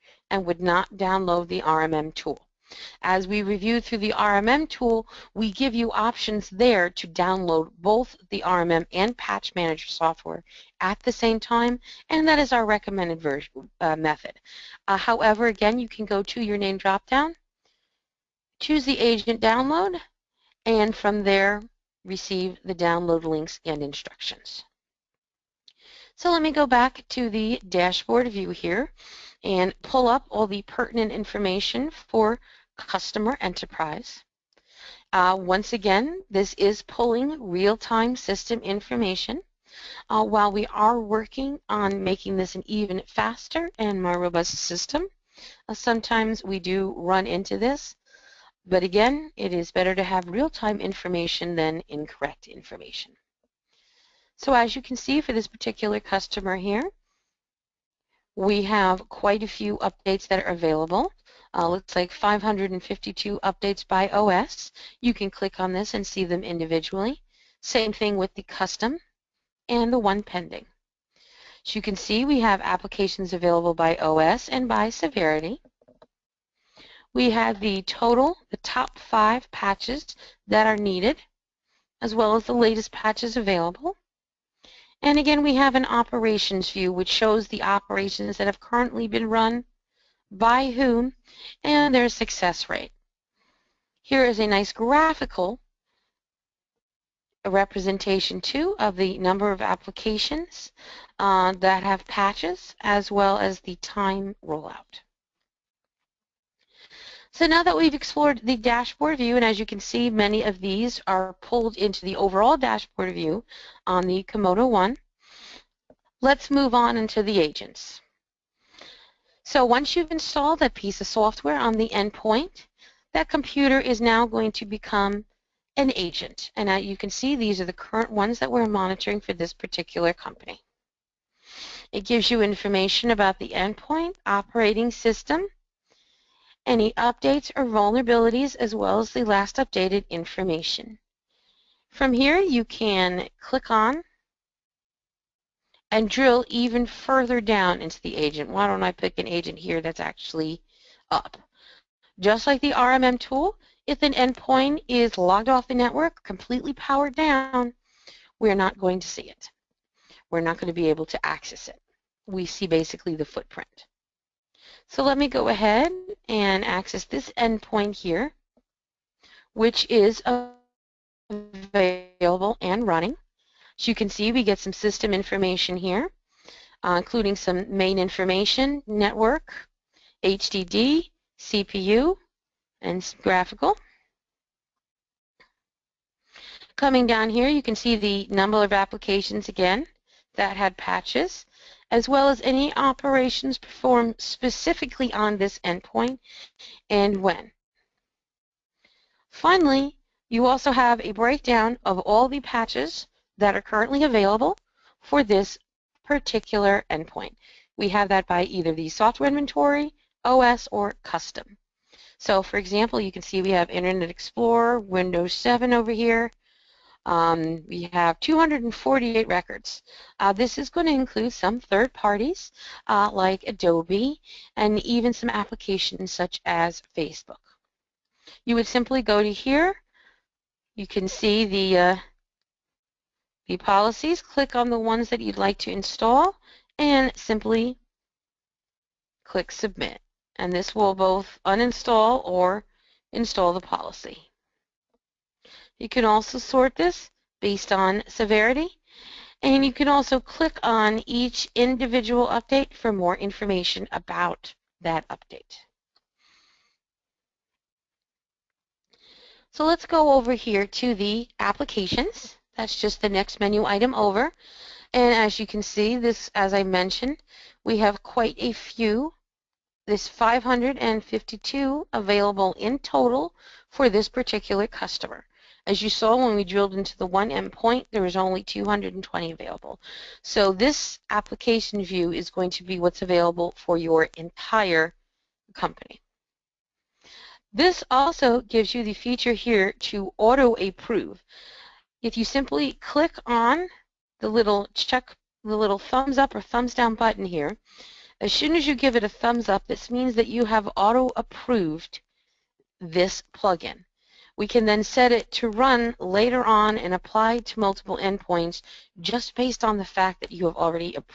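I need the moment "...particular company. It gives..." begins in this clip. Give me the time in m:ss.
2:09.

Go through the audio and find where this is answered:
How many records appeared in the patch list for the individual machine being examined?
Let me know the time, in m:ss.
3:38.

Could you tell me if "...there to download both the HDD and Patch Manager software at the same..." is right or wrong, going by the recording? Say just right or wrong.
wrong.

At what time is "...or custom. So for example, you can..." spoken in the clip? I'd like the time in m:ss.
3:30.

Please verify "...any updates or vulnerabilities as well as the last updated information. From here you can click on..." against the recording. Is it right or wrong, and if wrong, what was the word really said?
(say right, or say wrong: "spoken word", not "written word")
right.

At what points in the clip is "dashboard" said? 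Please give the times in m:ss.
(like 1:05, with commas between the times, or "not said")
0:27, 1:48, 1:52.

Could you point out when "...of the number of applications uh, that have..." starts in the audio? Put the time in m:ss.
1:38.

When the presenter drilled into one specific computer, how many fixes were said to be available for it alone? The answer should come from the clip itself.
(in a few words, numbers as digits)
220.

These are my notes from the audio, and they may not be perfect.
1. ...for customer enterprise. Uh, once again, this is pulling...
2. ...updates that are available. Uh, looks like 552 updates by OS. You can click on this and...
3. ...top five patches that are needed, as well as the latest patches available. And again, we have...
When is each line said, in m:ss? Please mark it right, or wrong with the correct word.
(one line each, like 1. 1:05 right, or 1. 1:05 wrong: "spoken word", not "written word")
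1. 0:31 right
2. 0:59 right
3. 1:18 right.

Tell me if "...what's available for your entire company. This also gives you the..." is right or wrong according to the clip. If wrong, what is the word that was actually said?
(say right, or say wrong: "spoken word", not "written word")
right.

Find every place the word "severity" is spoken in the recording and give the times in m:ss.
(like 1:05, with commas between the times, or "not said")
1:14, 4:08.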